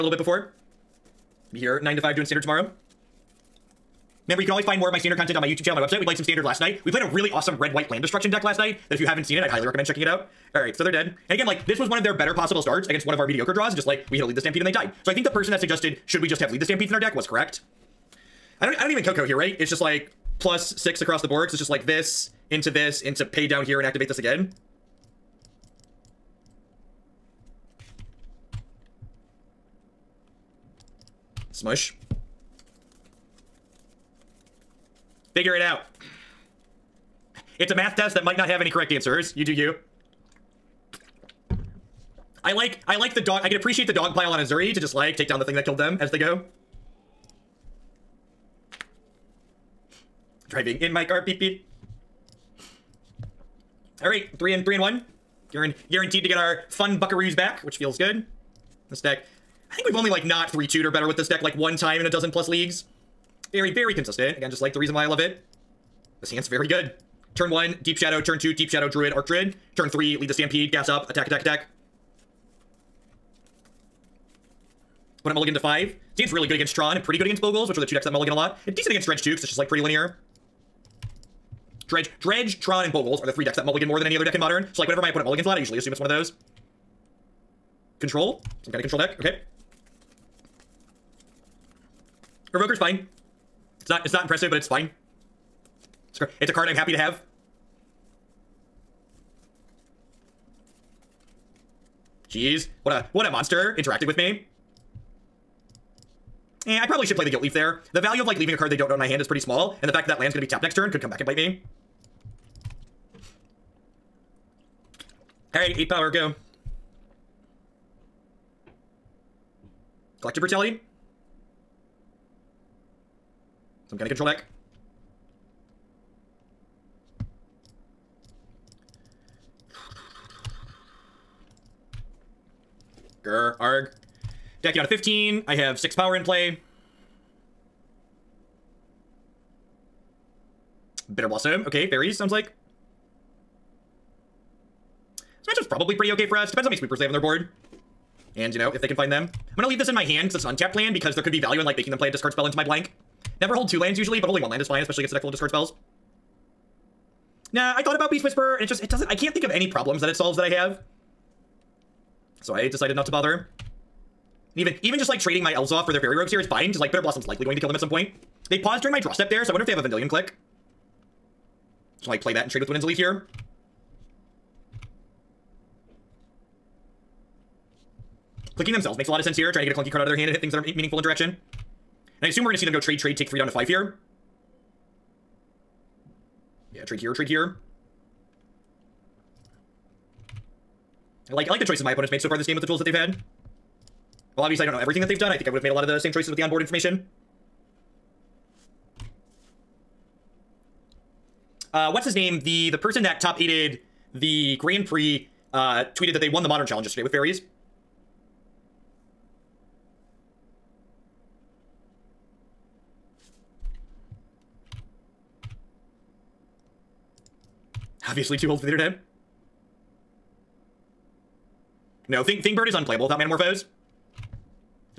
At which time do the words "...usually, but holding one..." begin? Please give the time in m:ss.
2:33.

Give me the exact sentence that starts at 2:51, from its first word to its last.
So like play that and trade with Dwynen's Elite here.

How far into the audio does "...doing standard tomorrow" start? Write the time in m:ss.
0:02.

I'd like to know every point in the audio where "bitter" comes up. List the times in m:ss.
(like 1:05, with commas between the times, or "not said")
2:21, 2:46.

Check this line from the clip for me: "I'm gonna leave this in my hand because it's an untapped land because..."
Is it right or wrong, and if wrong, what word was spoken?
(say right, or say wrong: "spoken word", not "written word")
right.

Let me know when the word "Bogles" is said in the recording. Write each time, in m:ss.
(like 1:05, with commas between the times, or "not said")
1:17, 1:22.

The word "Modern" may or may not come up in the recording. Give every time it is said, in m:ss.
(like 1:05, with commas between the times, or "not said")
1:24, 3:26.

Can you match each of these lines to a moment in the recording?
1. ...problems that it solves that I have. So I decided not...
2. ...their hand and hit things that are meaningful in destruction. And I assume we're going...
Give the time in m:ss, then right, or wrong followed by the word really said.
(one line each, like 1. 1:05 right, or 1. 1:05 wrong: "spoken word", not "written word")
1. 2:39 right
2. 3:00 wrong: "direction", not "destruction".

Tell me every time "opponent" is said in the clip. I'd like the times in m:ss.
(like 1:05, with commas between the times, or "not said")
1:25, 3:11.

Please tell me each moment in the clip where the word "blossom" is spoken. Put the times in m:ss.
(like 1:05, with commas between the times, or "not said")
2:21, 2:47.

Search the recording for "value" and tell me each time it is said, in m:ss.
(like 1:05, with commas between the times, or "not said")
1:47, 2:31.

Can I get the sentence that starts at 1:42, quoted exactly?
Jeez, what a what a monster interacting with me.